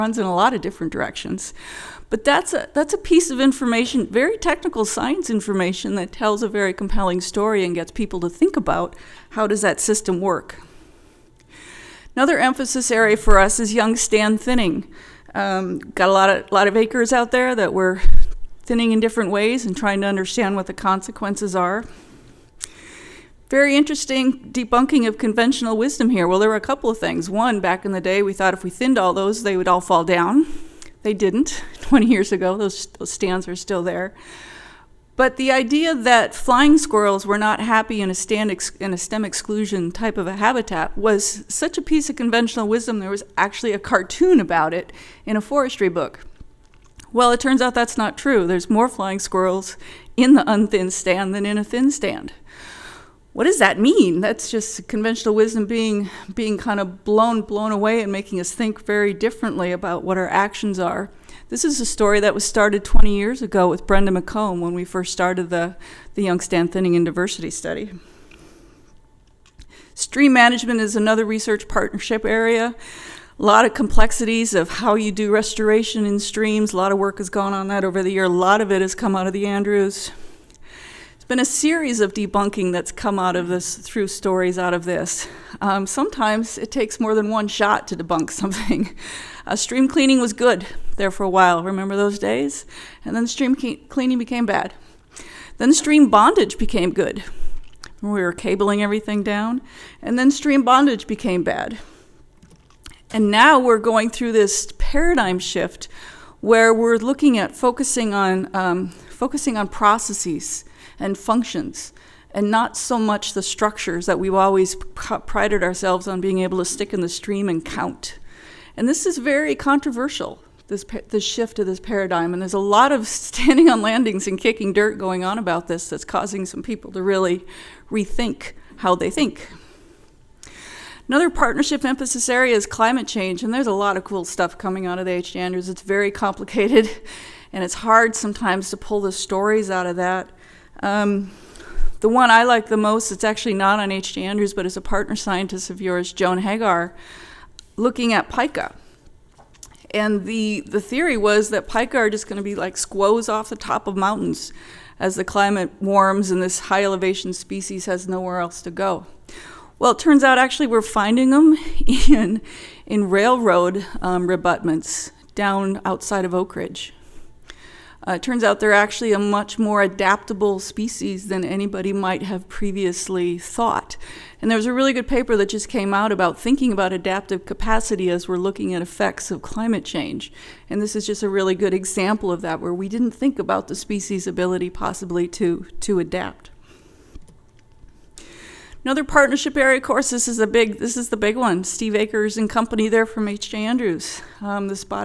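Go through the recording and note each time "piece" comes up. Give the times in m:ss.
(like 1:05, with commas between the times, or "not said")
0:02, 0:41.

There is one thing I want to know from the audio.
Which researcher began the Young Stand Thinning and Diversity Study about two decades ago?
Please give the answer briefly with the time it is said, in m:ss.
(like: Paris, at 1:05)
Brenda McComb, at 1:03.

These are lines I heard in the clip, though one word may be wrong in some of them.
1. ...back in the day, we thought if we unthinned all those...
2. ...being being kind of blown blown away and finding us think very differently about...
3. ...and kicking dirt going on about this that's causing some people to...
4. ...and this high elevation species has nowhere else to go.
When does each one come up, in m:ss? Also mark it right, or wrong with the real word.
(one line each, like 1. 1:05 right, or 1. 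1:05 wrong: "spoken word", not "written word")
1. 0:27 wrong: "thinned", not "unthinned"
2. 0:55 wrong: "making", not "finding"
3. 2:04 right
4. 2:36 right.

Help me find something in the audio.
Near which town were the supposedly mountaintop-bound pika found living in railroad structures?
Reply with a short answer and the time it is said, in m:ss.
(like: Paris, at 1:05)
Oakridge, at 2:46.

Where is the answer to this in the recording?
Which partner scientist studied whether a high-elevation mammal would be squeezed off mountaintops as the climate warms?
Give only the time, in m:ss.
2:26.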